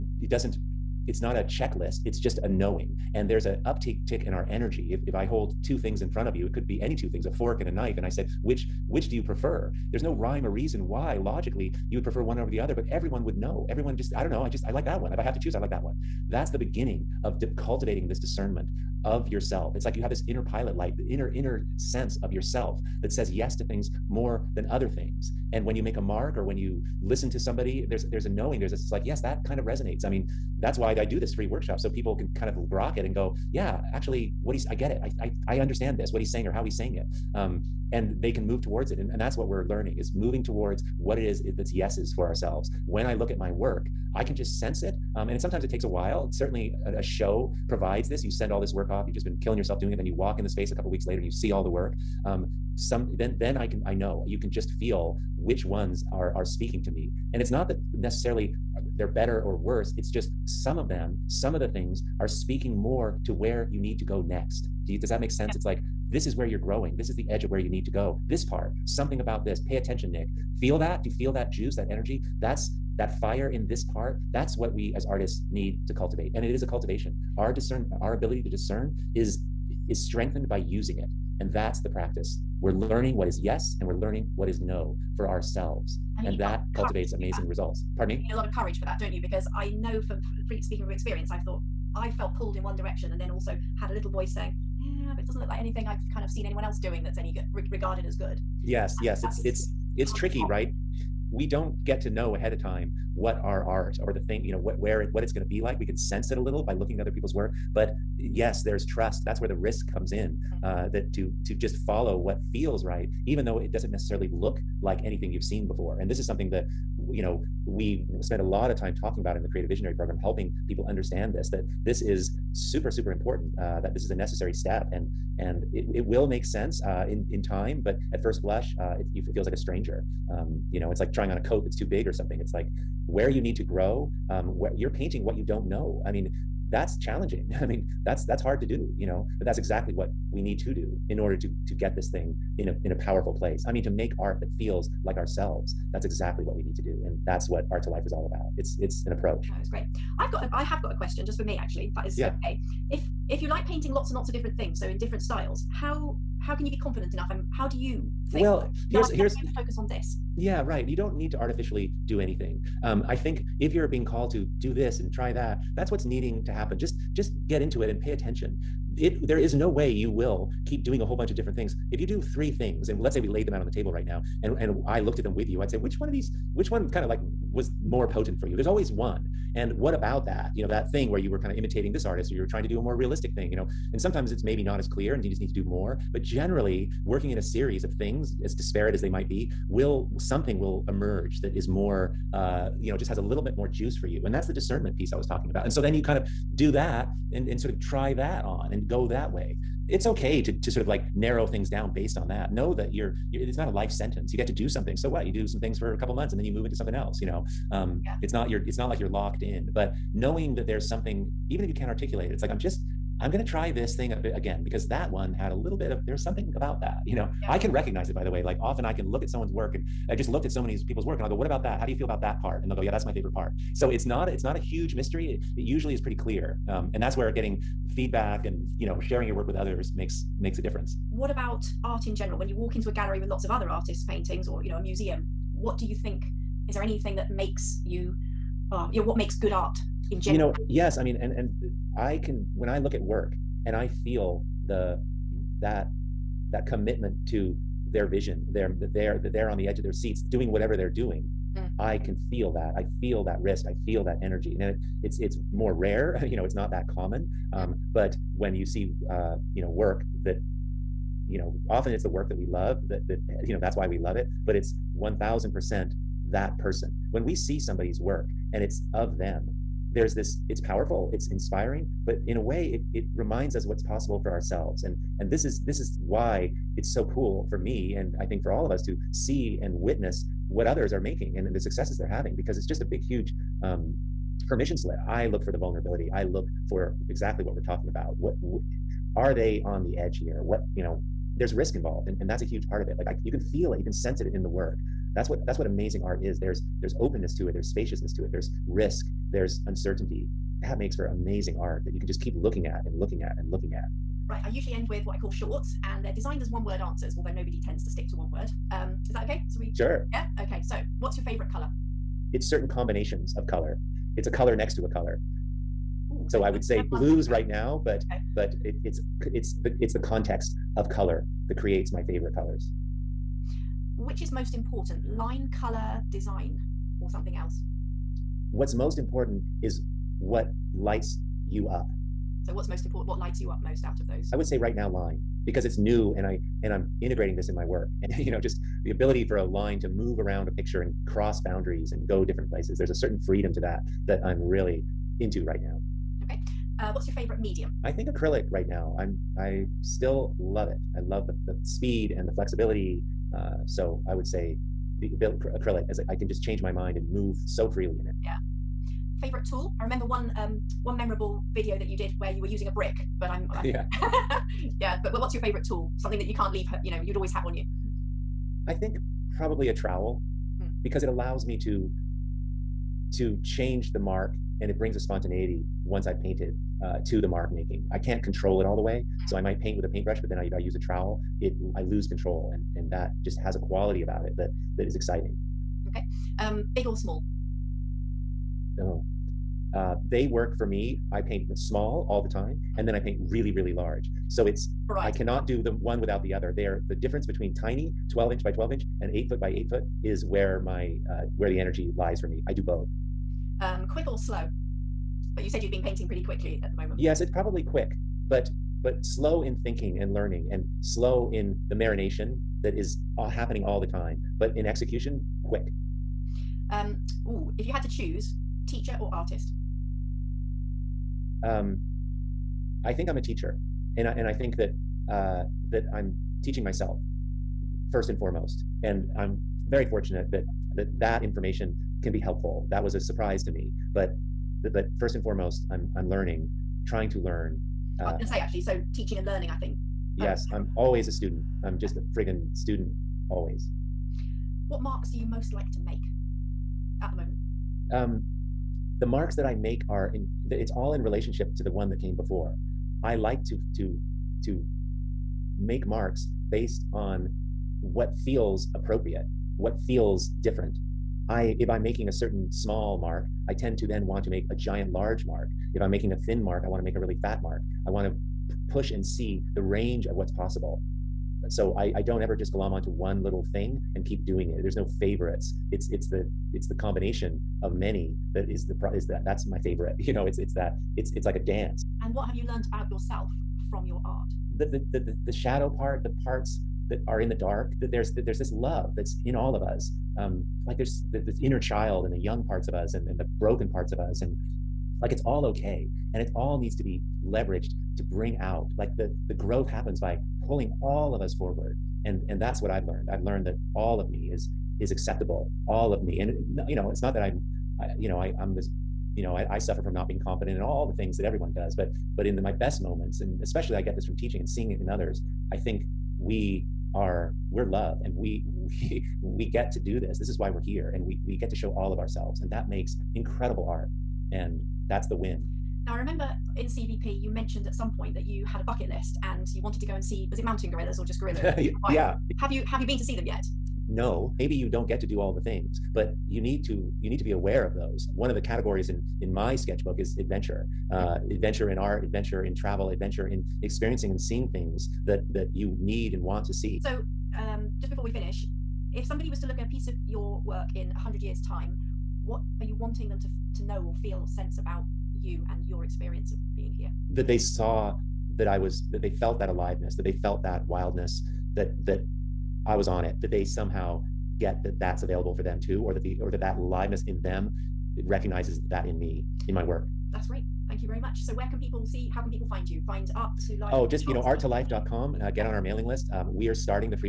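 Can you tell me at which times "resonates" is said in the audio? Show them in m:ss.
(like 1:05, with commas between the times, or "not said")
0:29.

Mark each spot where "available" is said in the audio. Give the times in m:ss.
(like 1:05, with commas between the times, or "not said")
9:25.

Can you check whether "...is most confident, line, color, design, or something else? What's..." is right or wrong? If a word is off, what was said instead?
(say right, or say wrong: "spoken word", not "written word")
wrong: "important", not "confident".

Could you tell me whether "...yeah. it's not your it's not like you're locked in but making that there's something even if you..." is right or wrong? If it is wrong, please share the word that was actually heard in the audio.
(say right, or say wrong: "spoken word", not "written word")
wrong: "knowing", not "making".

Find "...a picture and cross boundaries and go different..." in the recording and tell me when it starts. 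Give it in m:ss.
5:40.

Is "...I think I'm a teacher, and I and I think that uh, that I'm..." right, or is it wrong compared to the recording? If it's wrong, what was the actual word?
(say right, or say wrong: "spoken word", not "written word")
right.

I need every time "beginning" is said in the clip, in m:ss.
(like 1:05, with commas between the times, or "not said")
0:16.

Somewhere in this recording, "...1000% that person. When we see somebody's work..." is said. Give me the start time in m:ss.
4:24.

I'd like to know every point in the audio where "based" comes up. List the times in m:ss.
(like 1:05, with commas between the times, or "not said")
3:21, 7:36.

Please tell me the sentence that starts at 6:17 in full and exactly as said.
I can't control it all the way.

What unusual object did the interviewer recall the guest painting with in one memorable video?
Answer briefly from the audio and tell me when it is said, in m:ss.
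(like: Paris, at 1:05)
A brick, at 6:02.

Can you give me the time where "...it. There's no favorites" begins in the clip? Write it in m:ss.
7:54.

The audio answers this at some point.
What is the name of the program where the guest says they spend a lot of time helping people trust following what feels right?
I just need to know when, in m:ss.
1:59.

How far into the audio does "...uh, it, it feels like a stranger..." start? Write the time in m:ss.
2:08.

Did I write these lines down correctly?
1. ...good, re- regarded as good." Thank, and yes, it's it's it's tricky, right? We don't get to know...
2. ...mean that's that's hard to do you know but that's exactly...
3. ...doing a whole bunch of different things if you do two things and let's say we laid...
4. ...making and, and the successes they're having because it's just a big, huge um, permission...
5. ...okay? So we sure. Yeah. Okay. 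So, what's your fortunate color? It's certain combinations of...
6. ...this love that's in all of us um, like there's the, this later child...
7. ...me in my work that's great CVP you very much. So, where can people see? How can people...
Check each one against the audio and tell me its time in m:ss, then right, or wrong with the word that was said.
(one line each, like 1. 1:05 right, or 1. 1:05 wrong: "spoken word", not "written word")
1. 1:37 wrong: "Yes", not "Thank"
2. 2:17 right
3. 2:50 wrong: "three", not "two"
4. 4:41 right
5. 5:09 wrong: "favorite", not "fortunate"
6. 8:08 wrong: "inner", not "later"
7. 9:28 wrong: "Thank", not "CVP".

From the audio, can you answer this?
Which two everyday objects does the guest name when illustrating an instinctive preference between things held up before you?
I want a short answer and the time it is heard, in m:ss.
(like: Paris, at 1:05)
a fork and a knife, at 0:07.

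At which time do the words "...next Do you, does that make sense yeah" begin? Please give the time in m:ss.
1:04.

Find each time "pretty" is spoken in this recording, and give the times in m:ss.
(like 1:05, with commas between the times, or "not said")
3:45, 6:46.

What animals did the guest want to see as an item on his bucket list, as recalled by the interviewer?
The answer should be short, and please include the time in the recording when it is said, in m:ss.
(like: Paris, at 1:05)
Mountain gorillas, at 8:50.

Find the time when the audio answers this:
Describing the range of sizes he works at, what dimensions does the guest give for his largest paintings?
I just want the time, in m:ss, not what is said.
6:39.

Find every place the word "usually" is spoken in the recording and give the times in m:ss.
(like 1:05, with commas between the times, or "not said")
3:45, 5:04.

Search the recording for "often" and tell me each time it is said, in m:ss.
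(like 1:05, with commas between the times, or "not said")
3:38, 4:21.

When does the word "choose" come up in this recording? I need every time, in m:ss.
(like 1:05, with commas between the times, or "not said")
0:15, 6:57.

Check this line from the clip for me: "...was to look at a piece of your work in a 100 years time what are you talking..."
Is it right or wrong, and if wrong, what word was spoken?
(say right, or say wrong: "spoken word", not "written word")
wrong: "wanting", not "talking".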